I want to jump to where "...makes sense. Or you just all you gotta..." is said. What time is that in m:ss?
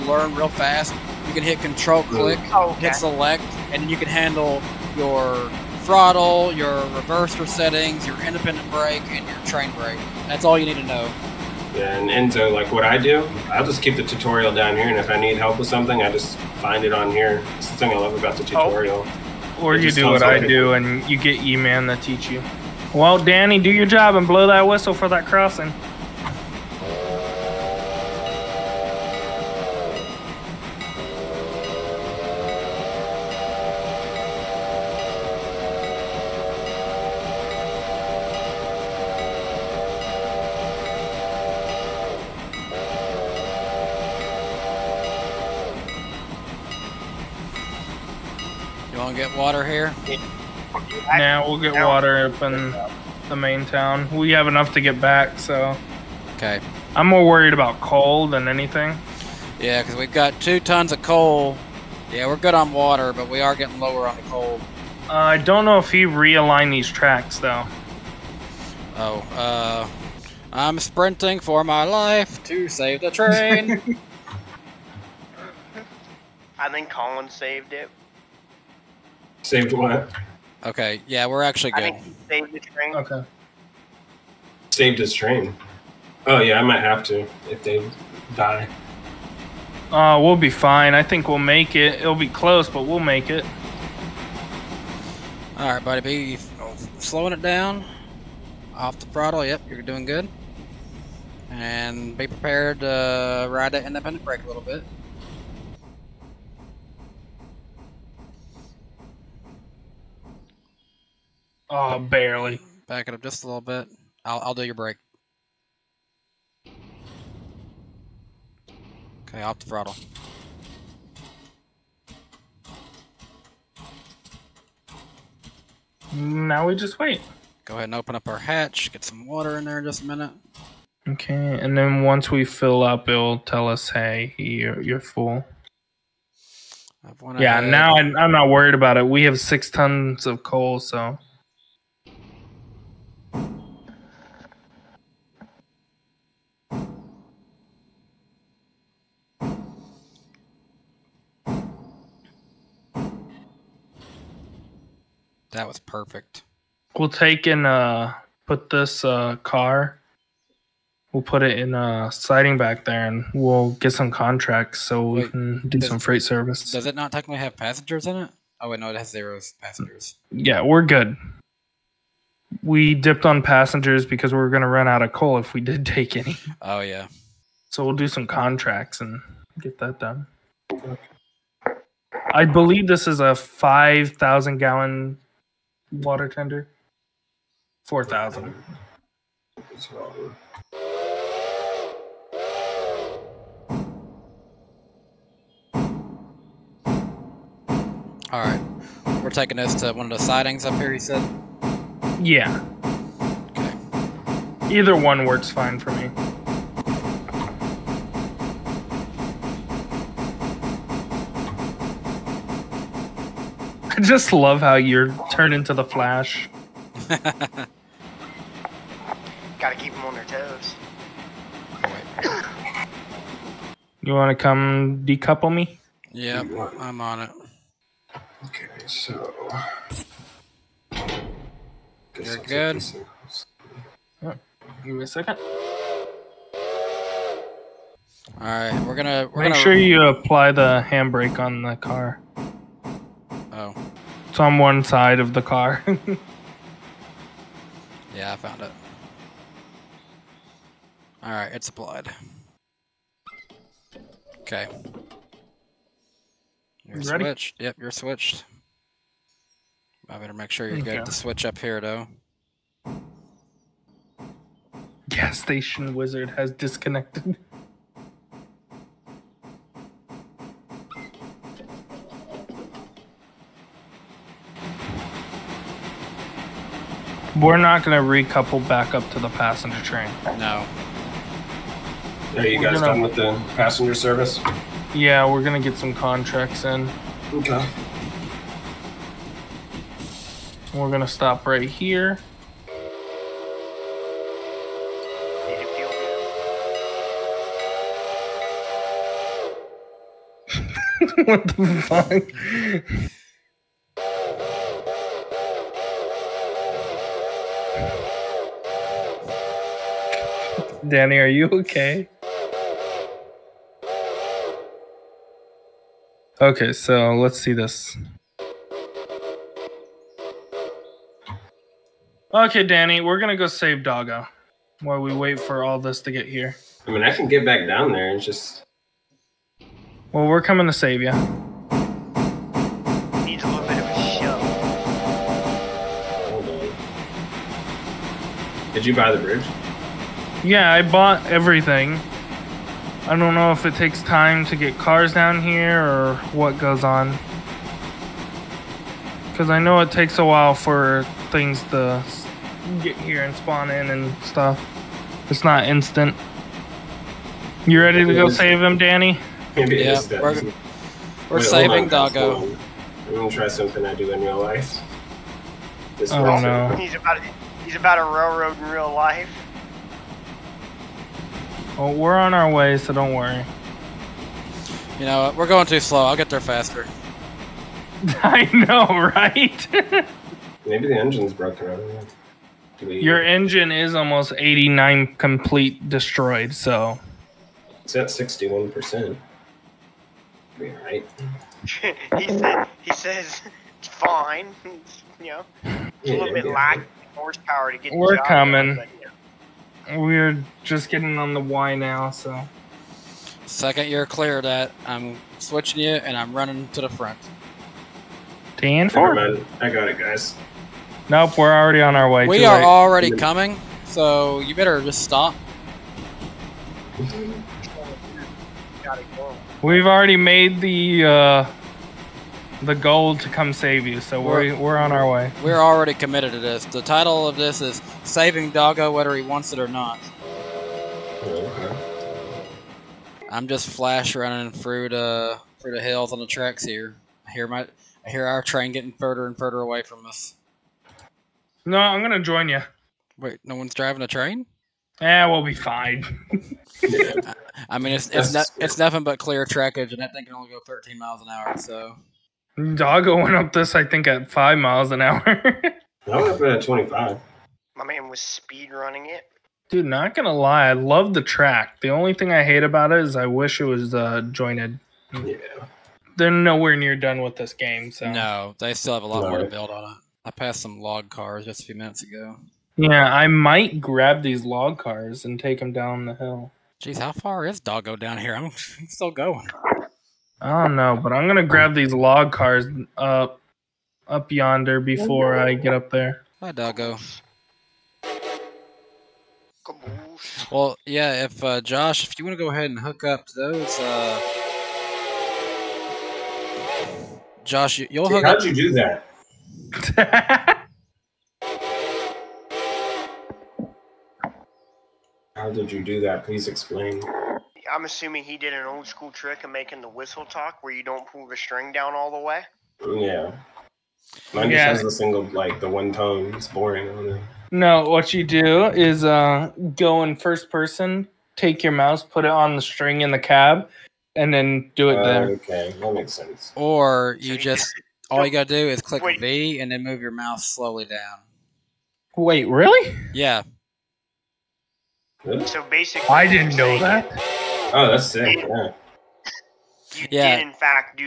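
8:45.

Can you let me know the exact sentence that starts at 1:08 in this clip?
Oh, uh, I'm sprinting for my life to save the train.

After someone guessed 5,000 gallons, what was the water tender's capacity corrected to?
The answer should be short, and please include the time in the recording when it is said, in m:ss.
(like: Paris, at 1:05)
4,000 gallons, at 3:07.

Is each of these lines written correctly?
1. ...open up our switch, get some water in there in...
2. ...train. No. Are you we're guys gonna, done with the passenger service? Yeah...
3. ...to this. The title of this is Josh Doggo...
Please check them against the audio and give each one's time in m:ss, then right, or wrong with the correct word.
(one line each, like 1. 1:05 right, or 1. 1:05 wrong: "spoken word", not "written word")
1. 2:07 wrong: "hatch", not "switch"
2. 4:39 right
3. 7:06 wrong: "Saving", not "Josh".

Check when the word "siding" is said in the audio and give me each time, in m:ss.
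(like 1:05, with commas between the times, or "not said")
2:42, 3:20.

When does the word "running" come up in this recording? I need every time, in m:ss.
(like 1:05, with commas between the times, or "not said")
6:46, 7:14, 7:38.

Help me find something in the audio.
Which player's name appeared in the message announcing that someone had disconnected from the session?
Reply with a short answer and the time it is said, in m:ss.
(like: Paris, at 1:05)
Gas station wizard, at 4:25.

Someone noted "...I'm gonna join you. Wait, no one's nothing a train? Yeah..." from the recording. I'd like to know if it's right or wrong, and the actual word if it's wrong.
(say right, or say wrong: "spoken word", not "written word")
wrong: "driving", not "nothing".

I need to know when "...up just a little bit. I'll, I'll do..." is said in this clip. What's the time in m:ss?
1:53.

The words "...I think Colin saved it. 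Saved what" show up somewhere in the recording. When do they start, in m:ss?
1:16.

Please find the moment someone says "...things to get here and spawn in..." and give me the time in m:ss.
5:51.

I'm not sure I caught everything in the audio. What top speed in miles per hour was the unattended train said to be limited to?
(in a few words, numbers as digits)
13.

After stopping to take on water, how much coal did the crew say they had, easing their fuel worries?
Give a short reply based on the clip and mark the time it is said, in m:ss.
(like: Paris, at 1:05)
6 tons, at 2:19.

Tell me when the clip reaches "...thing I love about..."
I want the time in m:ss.
0:17.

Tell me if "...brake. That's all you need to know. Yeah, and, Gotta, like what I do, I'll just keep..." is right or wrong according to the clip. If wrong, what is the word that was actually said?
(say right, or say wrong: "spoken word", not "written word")
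wrong: "Enzo", not "Gotta".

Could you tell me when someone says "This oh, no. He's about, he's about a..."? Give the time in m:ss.
6:05.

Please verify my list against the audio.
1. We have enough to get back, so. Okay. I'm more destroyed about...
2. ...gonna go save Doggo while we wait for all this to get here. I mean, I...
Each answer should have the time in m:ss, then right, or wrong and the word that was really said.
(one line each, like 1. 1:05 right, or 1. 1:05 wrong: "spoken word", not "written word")
1. 0:54 wrong: "worried", not "destroyed"
2. 5:23 right.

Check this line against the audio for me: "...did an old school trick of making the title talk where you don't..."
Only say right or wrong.
wrong.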